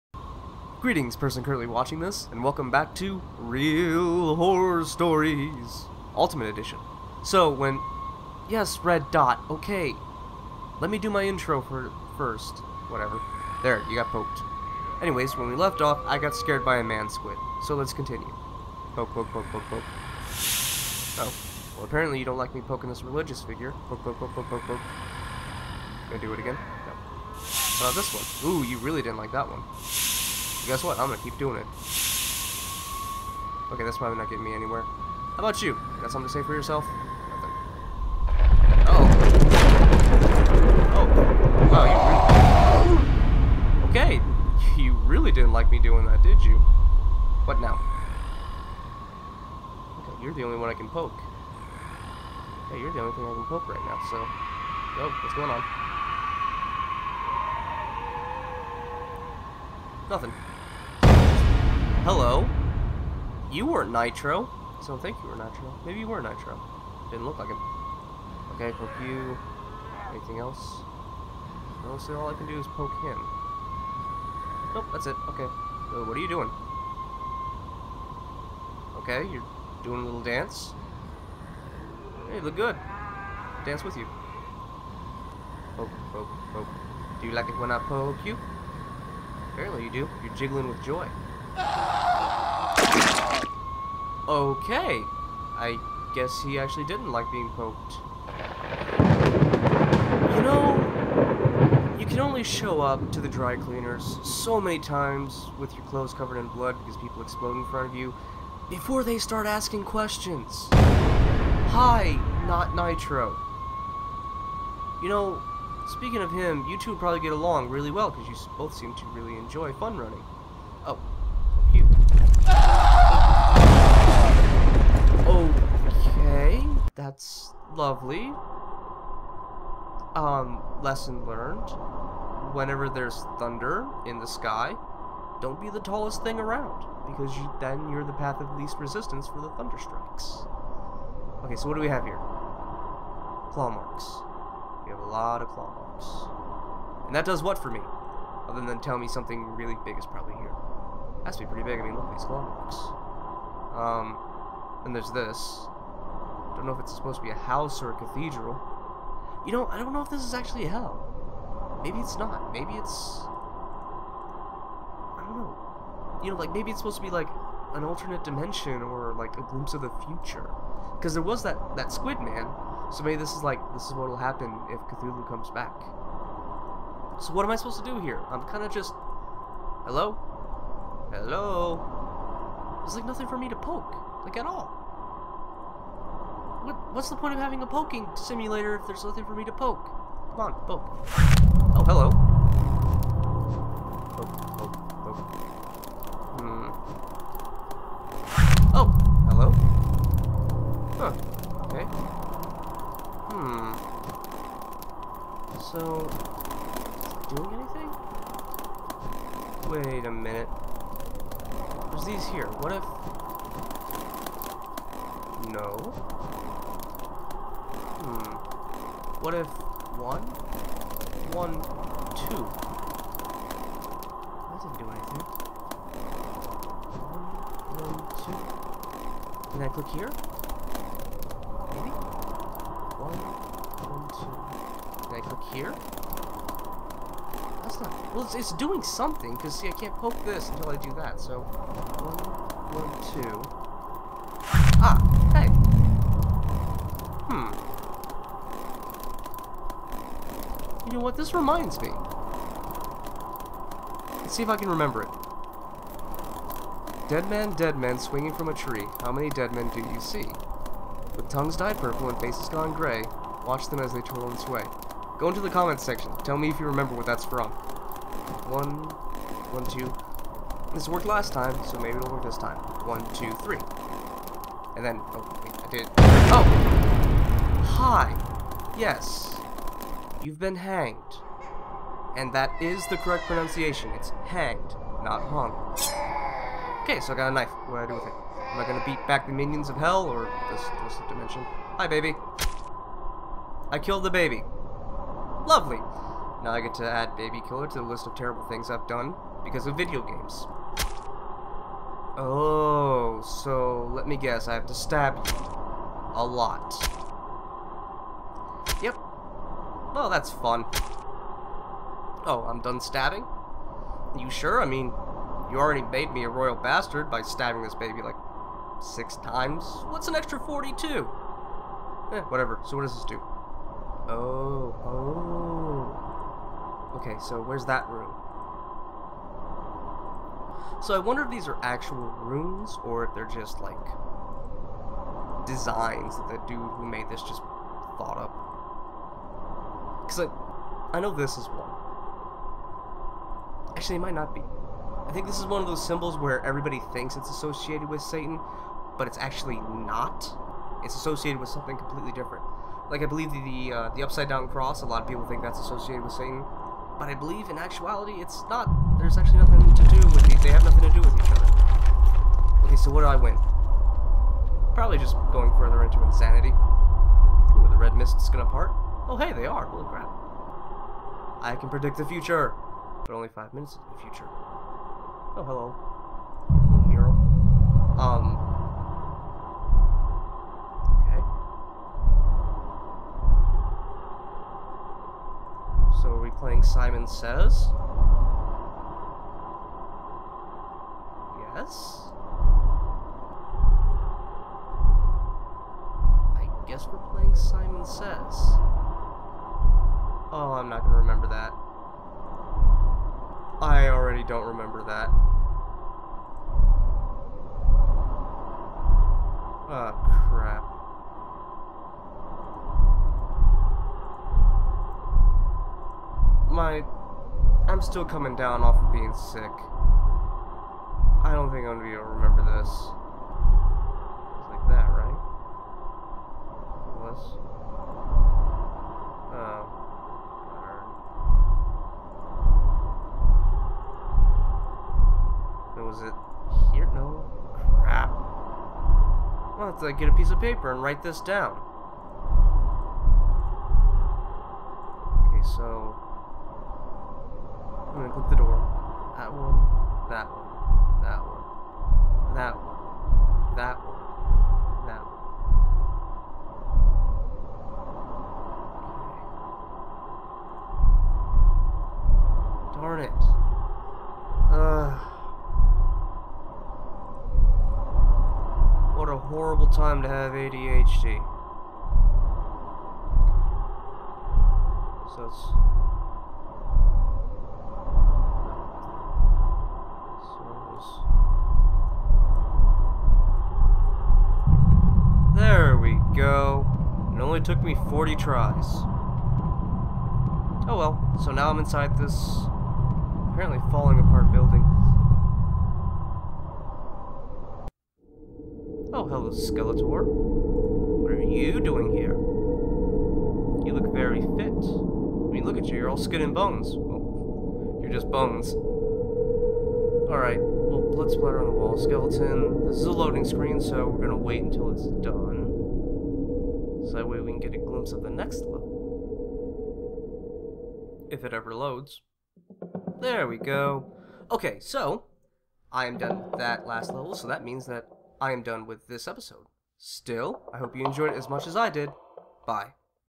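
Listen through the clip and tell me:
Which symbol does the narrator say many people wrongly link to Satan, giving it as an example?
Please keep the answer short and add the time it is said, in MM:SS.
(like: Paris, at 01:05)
The upside down cross, at 05:54.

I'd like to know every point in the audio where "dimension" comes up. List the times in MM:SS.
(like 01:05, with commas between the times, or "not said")
02:48, 04:51.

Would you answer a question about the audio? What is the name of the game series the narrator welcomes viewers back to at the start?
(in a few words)
Real Horror Stories Ultimate Edition.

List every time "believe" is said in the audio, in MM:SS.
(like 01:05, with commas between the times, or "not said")
05:53, 05:57.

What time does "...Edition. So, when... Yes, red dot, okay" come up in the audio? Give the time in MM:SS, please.
00:06.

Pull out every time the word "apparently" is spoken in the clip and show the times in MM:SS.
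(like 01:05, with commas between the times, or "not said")
00:21, 01:29, 08:13.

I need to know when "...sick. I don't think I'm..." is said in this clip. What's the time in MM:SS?
06:59.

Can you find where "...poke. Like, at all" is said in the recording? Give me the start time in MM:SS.
03:03.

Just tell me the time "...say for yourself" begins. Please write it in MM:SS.
00:36.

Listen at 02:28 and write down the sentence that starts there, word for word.
Other than tell me something really big is probably here.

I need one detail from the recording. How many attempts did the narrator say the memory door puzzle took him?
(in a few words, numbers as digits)
40.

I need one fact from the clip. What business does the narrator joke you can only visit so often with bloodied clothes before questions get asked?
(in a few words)
The dry cleaners.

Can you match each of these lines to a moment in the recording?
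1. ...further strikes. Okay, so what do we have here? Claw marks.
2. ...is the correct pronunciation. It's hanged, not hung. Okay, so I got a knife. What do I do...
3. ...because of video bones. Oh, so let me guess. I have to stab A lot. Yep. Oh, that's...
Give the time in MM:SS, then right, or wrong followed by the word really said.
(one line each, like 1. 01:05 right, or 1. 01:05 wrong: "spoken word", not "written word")
1. 02:19 wrong: "thunder", not "further"
2. 04:42 right
3. 04:59 wrong: "games", not "bones".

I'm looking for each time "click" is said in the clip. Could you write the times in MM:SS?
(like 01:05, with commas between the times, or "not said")
03:49, 03:55, 07:28.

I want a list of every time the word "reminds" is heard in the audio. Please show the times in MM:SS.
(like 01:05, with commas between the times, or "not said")
04:11.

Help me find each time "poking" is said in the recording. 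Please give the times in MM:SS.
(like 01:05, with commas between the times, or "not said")
00:22, 03:07.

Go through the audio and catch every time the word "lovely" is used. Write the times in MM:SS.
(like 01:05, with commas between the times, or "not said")
02:07, 04:55.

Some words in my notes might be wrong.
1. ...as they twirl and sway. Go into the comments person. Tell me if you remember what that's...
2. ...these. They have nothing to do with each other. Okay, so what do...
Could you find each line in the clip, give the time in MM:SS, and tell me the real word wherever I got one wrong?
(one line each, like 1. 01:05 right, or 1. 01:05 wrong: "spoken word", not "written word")
1. 04:23 wrong: "section", not "person"
2. 06:00 right.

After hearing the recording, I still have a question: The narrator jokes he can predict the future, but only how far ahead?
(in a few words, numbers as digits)
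5 minutes.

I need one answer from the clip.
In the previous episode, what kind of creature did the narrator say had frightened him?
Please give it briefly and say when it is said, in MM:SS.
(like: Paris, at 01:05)
A man squid, at 00:16.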